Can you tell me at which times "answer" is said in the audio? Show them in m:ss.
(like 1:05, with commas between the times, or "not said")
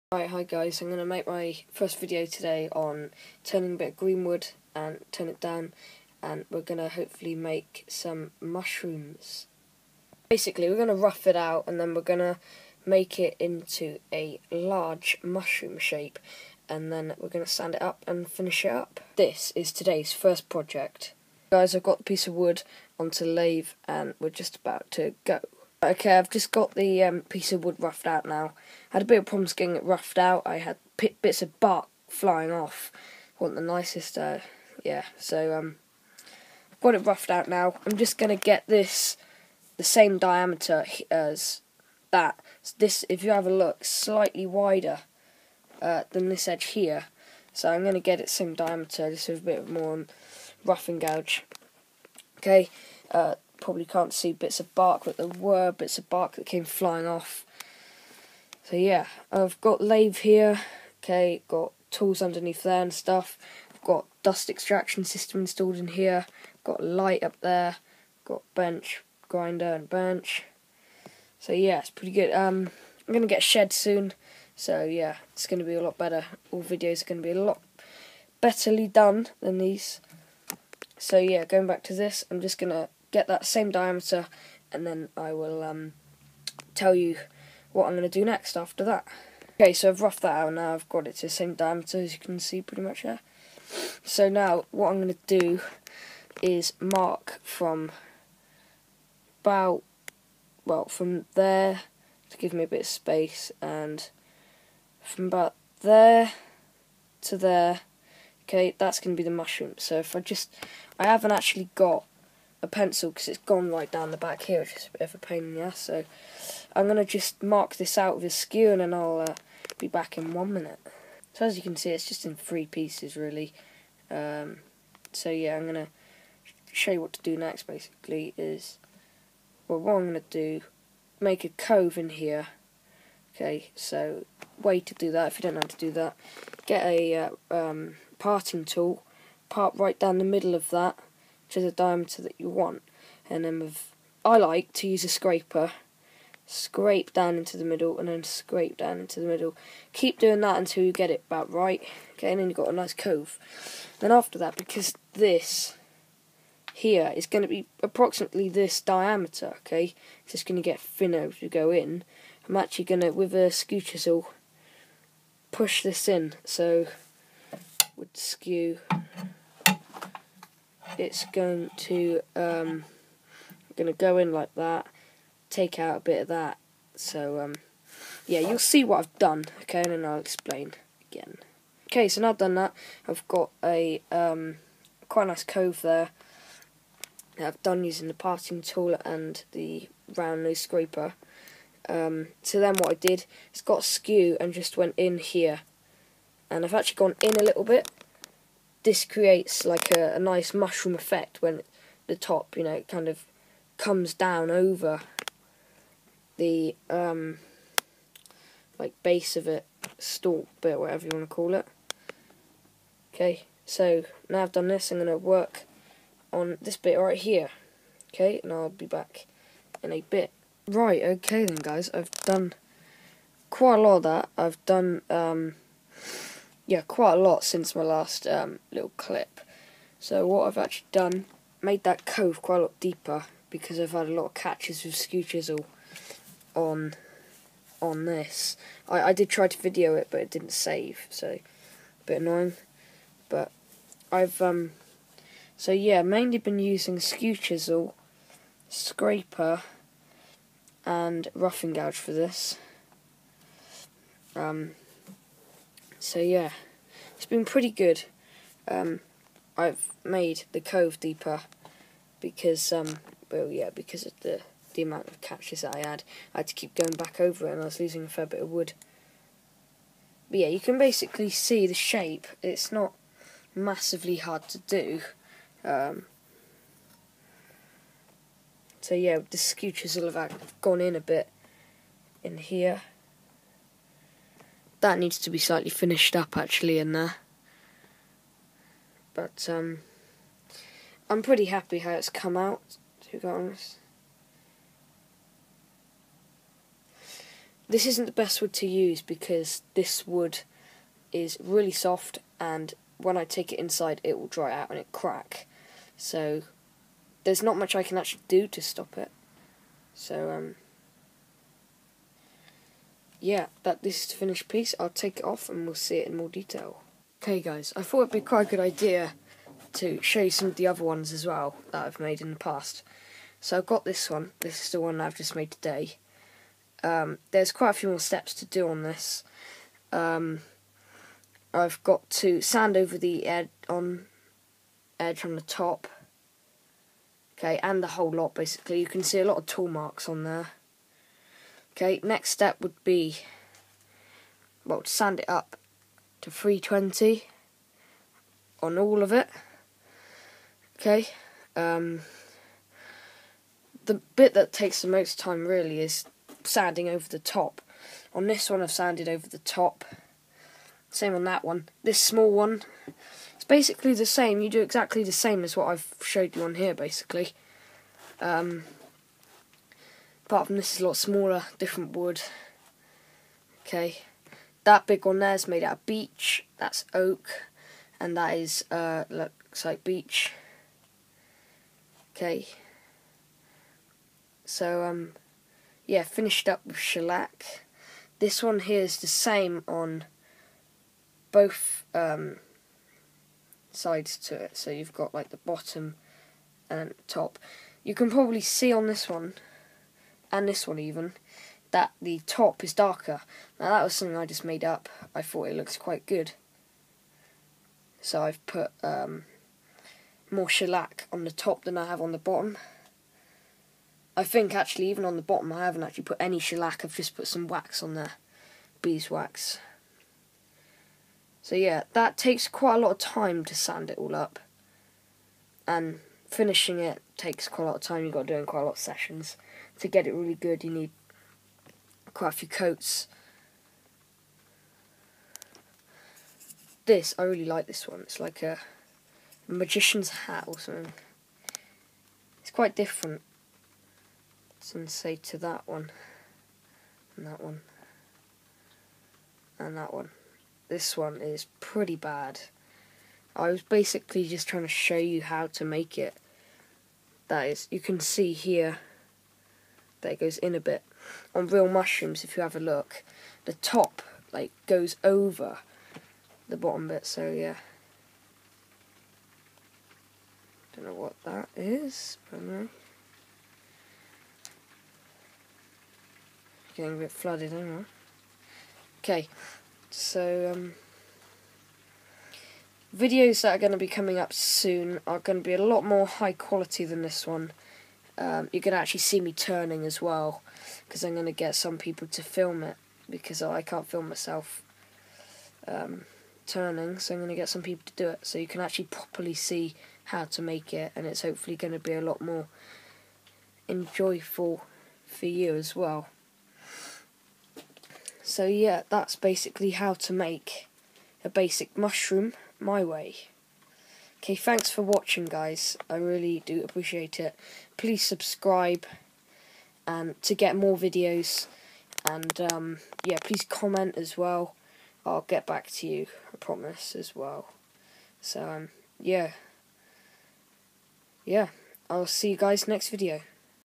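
not said.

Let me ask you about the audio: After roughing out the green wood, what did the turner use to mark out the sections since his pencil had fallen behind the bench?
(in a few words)
A skewer.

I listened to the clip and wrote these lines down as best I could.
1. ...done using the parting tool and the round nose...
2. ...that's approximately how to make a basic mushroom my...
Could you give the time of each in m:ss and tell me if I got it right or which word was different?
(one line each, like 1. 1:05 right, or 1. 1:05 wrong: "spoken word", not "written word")
1. 3:07 right
2. 8:28 wrong: "basically", not "approximately".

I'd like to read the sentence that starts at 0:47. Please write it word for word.
So I'm gonna get it same diameter, just with a bit more roughing gouge.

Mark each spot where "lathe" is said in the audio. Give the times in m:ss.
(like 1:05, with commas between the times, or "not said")
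0:23, 0:59.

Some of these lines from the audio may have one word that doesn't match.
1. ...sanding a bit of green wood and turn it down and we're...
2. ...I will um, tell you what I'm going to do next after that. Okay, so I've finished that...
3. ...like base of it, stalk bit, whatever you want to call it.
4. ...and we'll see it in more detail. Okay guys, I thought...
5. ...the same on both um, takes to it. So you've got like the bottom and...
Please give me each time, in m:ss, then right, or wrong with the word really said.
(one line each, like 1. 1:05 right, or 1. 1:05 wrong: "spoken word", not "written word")
1. 0:03 wrong: "turning", not "sanding"
2. 1:25 wrong: "roughed", not "finished"
3. 3:28 right
4. 5:15 right
5. 6:29 wrong: "sides", not "takes".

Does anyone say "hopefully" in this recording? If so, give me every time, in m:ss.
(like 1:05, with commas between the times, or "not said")
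0:06, 8:21.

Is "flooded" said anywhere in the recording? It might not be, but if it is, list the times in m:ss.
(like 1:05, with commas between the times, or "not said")
7:57.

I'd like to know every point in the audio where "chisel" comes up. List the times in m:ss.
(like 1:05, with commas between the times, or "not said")
2:43, 3:55, 4:07.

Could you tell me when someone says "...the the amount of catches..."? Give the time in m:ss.
4:24.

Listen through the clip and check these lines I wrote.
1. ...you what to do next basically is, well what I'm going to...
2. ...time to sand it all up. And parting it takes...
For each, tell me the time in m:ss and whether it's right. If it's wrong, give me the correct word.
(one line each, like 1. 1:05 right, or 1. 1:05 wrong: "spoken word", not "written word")
1. 2:06 right
2. 7:02 wrong: "finishing", not "parting".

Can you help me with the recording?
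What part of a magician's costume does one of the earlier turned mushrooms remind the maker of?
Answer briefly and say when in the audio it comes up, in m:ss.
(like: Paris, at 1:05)
A magician's hat, at 7:19.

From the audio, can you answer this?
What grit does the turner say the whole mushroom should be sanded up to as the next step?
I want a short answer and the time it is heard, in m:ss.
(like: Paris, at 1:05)
320, at 5:46.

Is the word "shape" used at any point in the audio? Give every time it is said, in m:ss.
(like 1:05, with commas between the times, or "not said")
0:15, 4:31.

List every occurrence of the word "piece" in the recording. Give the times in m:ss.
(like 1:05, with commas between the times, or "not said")
0:22, 0:27, 2:02, 5:14.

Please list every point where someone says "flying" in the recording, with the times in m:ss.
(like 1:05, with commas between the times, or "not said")
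0:32, 0:56.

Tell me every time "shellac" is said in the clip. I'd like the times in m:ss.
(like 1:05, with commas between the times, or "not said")
6:26, 6:50, 6:56.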